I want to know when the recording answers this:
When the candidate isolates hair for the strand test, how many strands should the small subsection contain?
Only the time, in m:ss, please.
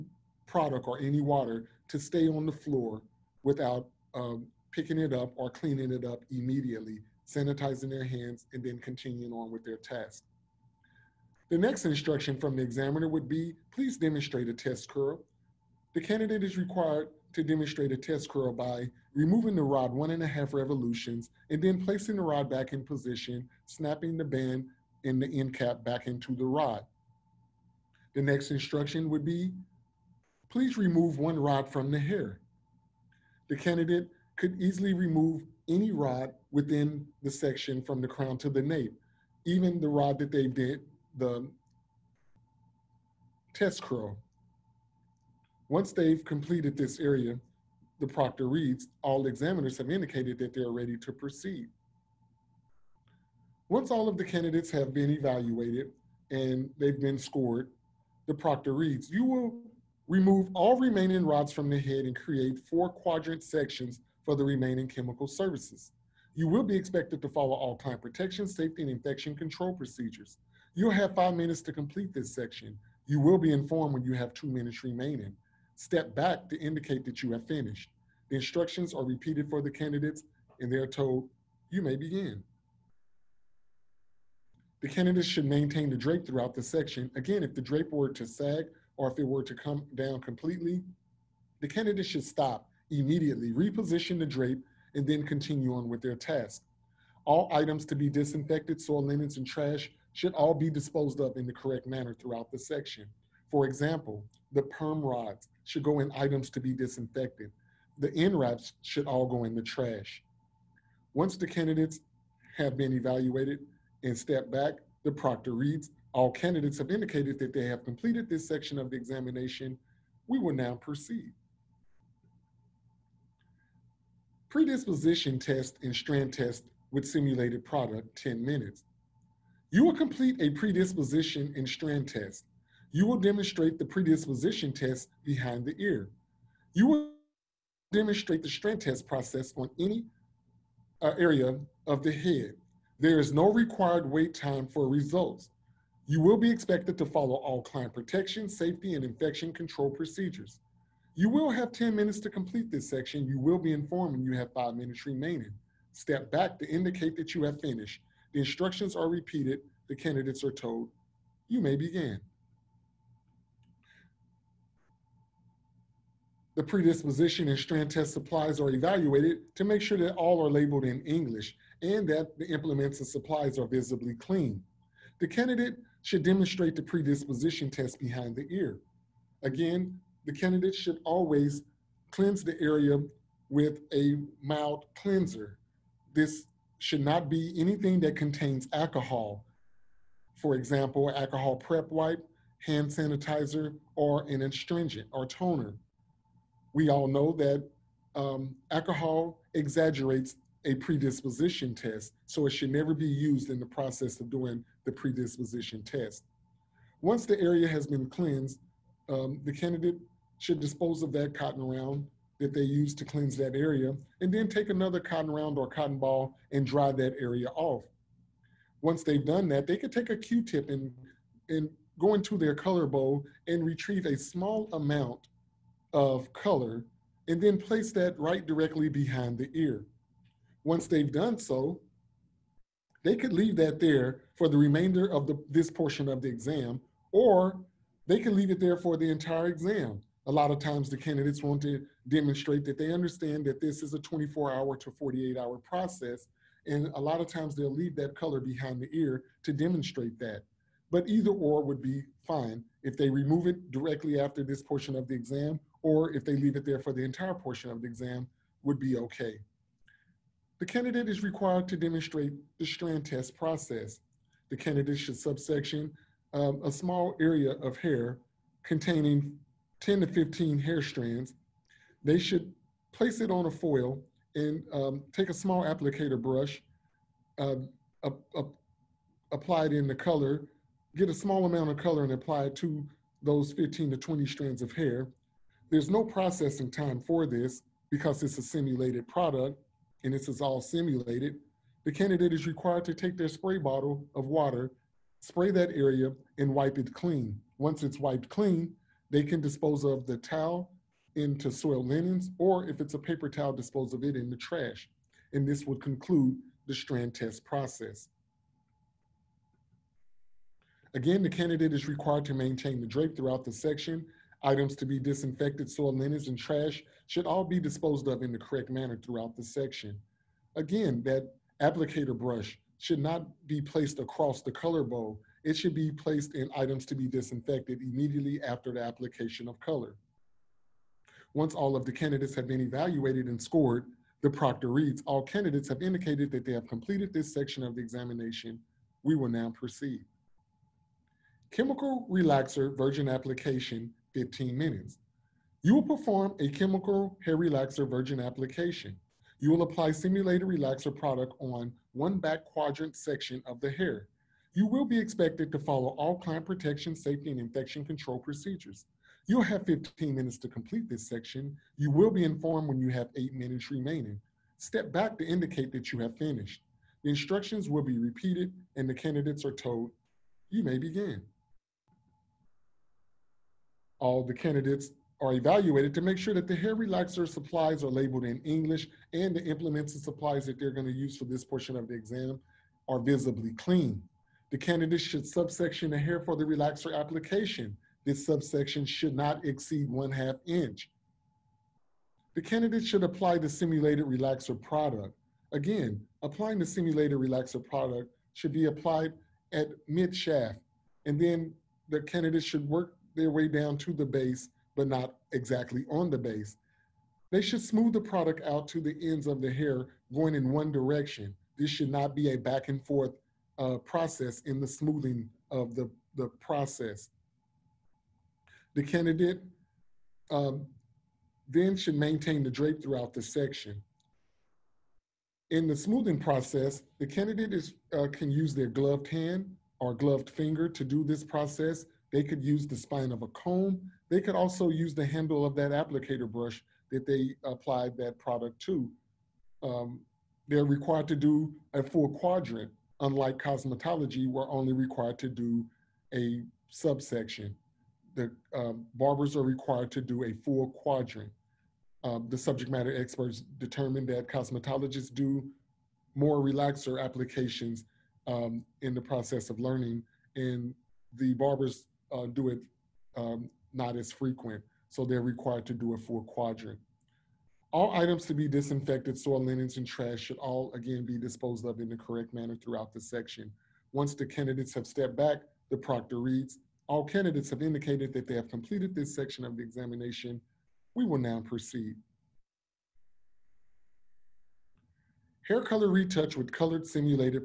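4:29.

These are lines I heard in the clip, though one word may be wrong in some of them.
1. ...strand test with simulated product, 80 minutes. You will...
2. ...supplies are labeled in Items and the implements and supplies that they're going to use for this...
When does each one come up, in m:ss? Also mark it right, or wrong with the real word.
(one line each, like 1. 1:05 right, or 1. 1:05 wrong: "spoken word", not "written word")
1. 2:05 wrong: "10", not "80"
2. 6:17 wrong: "English", not "Items".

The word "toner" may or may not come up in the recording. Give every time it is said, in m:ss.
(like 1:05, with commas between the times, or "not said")
3:15.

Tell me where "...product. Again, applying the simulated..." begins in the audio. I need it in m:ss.
6:34.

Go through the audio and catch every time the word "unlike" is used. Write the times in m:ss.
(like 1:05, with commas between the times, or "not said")
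7:22.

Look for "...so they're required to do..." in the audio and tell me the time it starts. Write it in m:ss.
7:44.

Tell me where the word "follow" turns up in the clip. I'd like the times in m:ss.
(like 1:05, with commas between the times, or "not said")
1:07, 2:27, 5:55.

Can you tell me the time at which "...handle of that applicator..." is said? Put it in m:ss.
7:15.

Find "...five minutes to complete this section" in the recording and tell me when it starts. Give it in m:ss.
1:11.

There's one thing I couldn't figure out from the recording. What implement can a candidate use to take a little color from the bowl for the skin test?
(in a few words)
Q-tip.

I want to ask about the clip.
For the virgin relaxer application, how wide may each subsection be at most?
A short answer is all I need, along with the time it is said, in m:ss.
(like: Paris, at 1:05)
One half inch, at 6:29.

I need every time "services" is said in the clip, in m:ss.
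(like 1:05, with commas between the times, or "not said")
1:05.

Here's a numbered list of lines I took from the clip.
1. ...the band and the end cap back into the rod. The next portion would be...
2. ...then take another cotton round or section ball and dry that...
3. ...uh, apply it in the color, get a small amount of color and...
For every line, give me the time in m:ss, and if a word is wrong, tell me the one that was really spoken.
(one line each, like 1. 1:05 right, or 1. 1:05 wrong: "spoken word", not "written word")
1. 0:24 wrong: "instruction", not "portion"
2. 3:34 wrong: "cotton", not "section"
3. 4:37 right.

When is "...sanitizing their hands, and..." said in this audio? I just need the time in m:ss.
0:07.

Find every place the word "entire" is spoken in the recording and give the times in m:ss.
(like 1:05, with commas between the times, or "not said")
3:59, 4:17.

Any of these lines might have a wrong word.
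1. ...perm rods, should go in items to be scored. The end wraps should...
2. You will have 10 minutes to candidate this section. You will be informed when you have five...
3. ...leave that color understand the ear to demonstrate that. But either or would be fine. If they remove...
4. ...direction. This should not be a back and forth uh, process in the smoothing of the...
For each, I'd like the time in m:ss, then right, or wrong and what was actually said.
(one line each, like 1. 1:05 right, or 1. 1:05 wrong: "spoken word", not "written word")
1. 1:44 wrong: "disinfected", not "scored"
2. 2:31 wrong: "complete", not "candidate"
3. 4:07 wrong: "behind", not "understand"
4. 6:50 right.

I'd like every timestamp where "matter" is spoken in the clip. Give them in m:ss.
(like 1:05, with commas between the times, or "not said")
7:32.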